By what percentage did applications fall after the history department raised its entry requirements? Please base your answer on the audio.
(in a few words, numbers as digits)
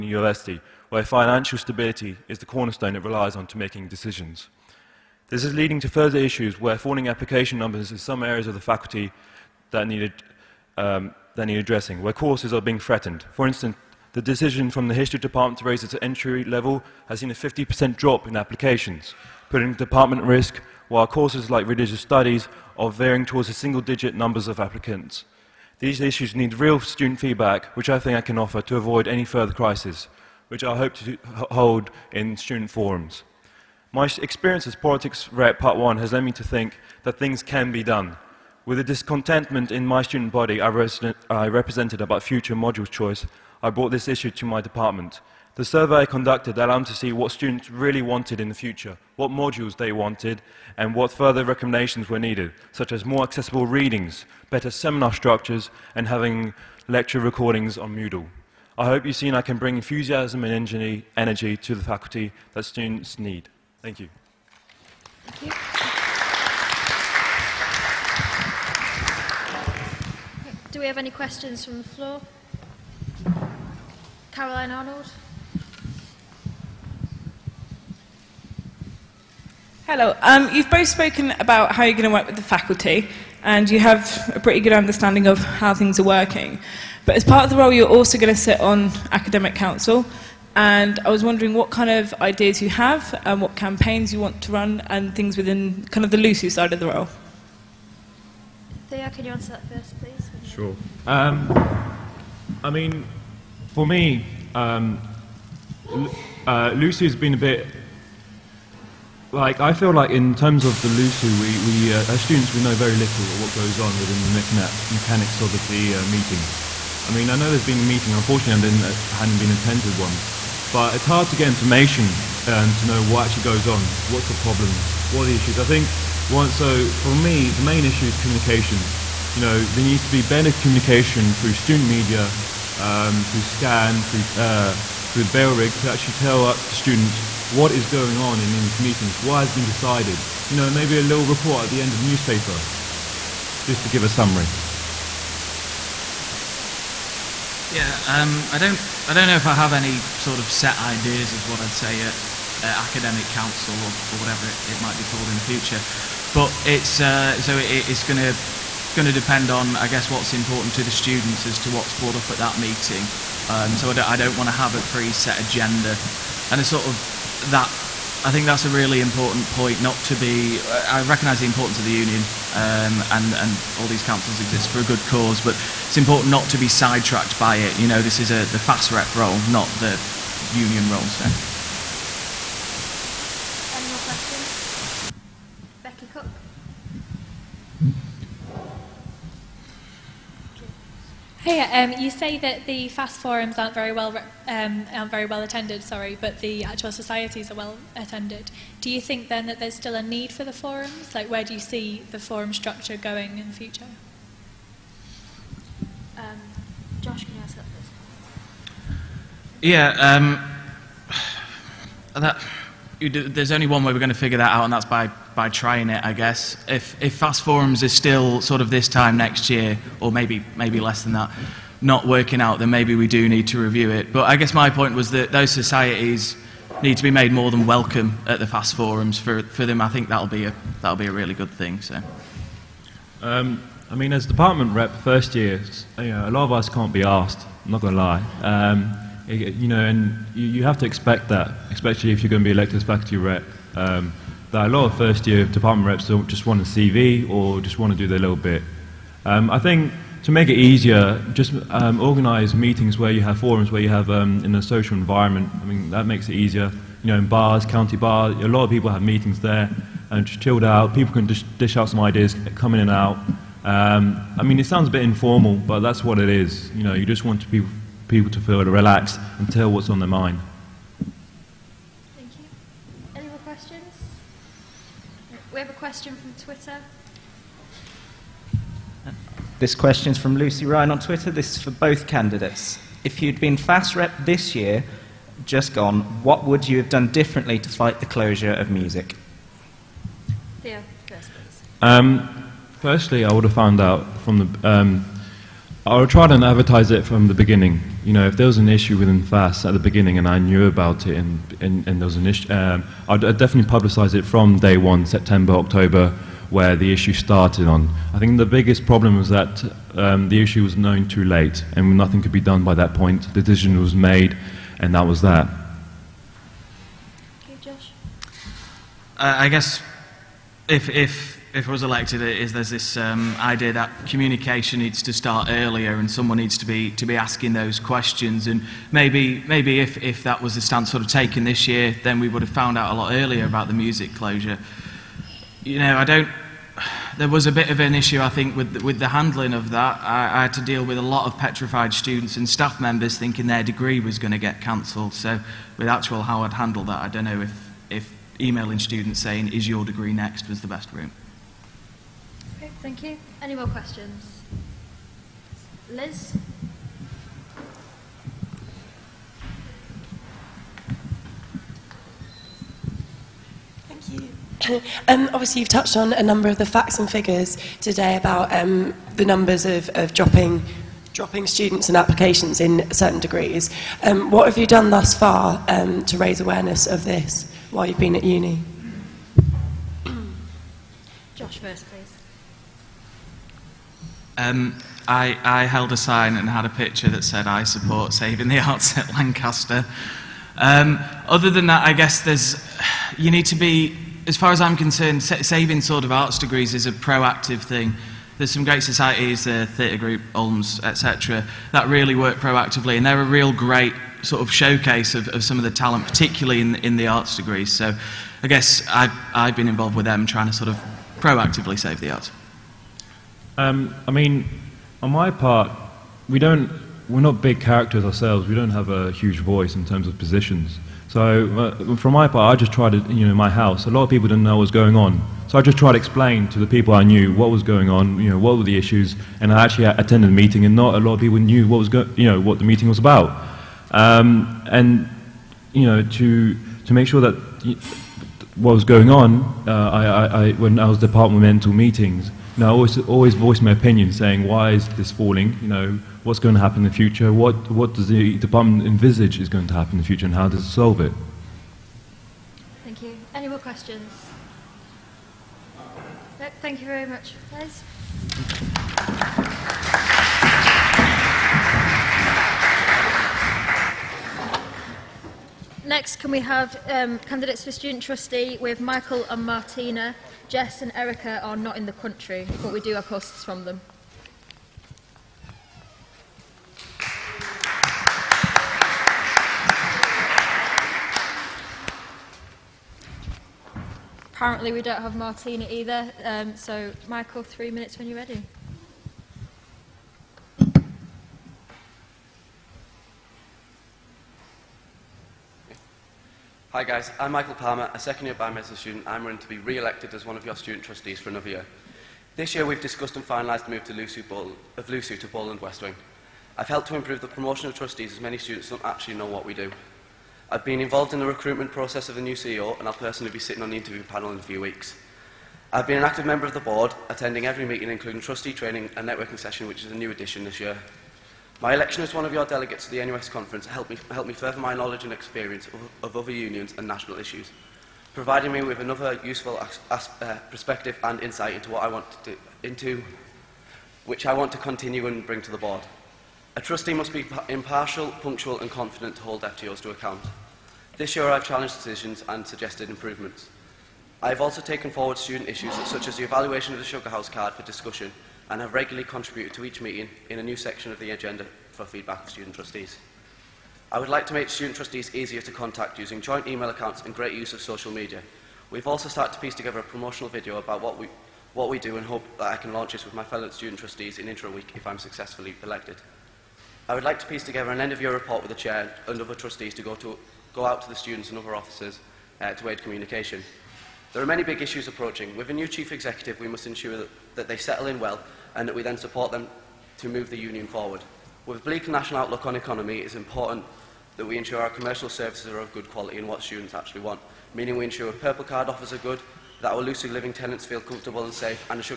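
50%.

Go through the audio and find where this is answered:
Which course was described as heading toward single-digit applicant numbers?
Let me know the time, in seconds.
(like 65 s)
21 s.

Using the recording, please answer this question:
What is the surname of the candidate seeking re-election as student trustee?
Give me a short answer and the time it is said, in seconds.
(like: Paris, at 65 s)
Palmer, at 497 s.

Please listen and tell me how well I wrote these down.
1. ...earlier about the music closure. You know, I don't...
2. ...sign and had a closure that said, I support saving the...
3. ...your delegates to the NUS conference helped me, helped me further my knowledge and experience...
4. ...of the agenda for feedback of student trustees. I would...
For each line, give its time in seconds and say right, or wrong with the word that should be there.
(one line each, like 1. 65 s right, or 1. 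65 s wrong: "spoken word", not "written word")
1. 333 s right
2. 385 s wrong: "picture", not "closure"
3. 522 s right
4. 550 s right.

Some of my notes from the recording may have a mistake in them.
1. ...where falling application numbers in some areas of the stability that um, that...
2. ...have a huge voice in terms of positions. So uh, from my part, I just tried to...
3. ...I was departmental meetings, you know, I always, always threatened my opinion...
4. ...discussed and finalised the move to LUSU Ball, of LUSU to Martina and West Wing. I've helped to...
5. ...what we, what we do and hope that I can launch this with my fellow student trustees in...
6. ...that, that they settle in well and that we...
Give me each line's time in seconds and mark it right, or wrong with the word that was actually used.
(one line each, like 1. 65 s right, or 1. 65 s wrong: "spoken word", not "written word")
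1. 6 s wrong: "faculty", not "stability"
2. 418 s right
3. 440 s wrong: "voiced", not "threatened"
4. 502 s wrong: "Ball", not "Martina"
5. 560 s right
6. 576 s right.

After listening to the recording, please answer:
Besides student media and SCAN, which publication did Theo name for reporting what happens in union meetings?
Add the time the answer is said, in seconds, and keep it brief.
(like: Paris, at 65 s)
Bailrigg, at 135 s.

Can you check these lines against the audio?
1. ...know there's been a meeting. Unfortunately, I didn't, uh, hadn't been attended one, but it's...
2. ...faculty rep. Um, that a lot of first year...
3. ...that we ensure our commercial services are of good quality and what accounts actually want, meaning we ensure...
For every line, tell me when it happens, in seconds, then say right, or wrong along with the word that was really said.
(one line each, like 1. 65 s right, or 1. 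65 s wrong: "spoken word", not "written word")
1. 117 s right
2. 242 s right
3. 584 s wrong: "students", not "accounts".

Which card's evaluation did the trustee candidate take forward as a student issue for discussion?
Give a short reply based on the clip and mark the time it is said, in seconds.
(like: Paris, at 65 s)
Sugar House card, at 546 s.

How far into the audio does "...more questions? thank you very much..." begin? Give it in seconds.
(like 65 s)
453 s.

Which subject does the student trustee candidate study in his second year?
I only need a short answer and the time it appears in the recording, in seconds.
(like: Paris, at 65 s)
Biomedicine, at 498 s.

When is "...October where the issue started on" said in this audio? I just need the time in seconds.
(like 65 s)
305 s.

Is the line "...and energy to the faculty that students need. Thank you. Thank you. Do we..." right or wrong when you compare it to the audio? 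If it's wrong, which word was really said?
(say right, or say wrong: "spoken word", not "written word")
right.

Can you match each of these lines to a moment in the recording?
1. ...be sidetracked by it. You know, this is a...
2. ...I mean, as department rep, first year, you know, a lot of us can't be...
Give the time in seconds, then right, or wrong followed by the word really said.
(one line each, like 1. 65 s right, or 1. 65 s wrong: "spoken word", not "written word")
1. 176 s right
2. 233 s right.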